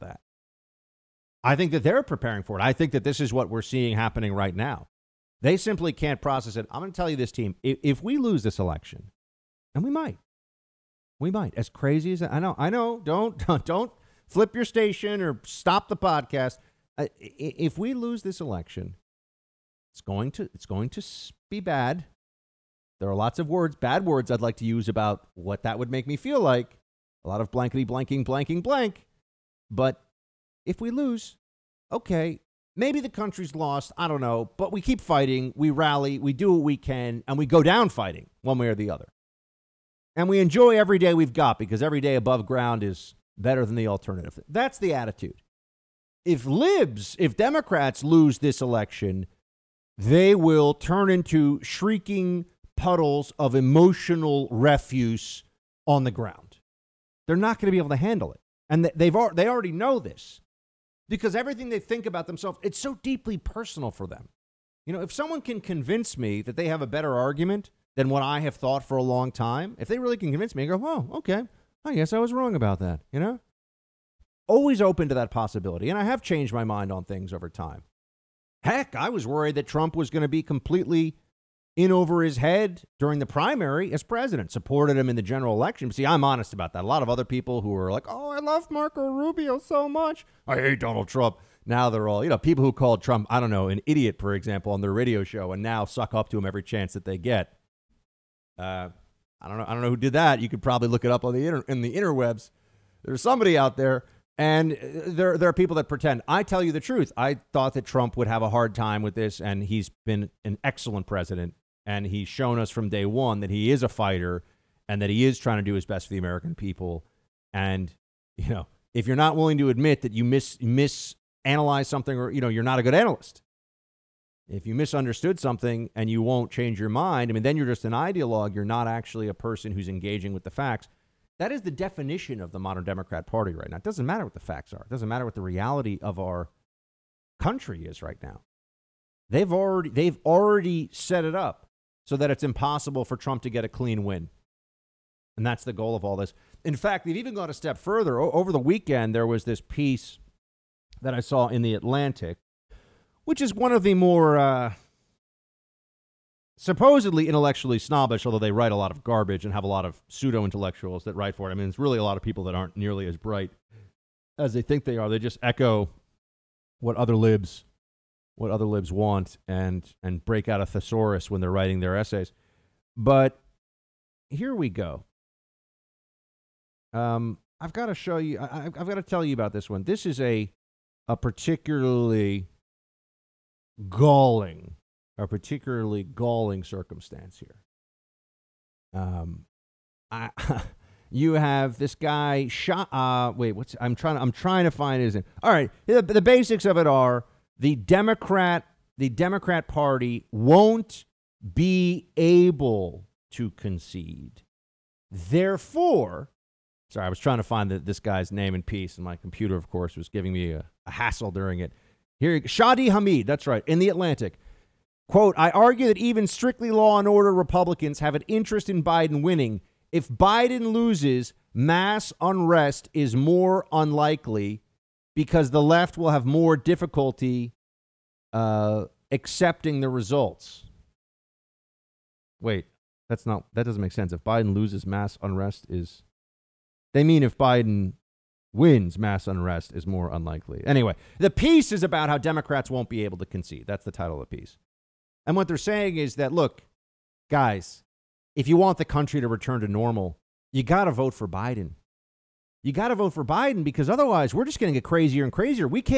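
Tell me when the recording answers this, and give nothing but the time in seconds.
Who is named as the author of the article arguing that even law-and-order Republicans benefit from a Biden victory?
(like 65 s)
212 s.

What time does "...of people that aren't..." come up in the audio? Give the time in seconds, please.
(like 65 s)
162 s.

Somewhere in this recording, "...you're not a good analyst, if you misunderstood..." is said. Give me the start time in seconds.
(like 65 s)
122 s.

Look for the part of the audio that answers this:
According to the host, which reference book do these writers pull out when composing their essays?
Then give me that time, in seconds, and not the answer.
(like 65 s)
170 s.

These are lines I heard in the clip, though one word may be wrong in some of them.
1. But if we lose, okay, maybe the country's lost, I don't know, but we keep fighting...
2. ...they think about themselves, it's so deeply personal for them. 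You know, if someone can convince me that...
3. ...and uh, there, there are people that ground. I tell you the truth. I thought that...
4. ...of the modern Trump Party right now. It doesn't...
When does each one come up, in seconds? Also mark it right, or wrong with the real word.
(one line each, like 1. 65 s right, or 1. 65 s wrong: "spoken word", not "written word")
1. 29 s right
2. 61 s right
3. 104 s wrong: "pretend", not "ground"
4. 132 s wrong: "Democrat", not "Trump".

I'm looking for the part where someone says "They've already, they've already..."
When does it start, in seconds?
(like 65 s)
139 s.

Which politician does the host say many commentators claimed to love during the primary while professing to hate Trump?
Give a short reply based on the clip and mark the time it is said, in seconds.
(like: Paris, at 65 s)
Marco Rubio, at 88 s.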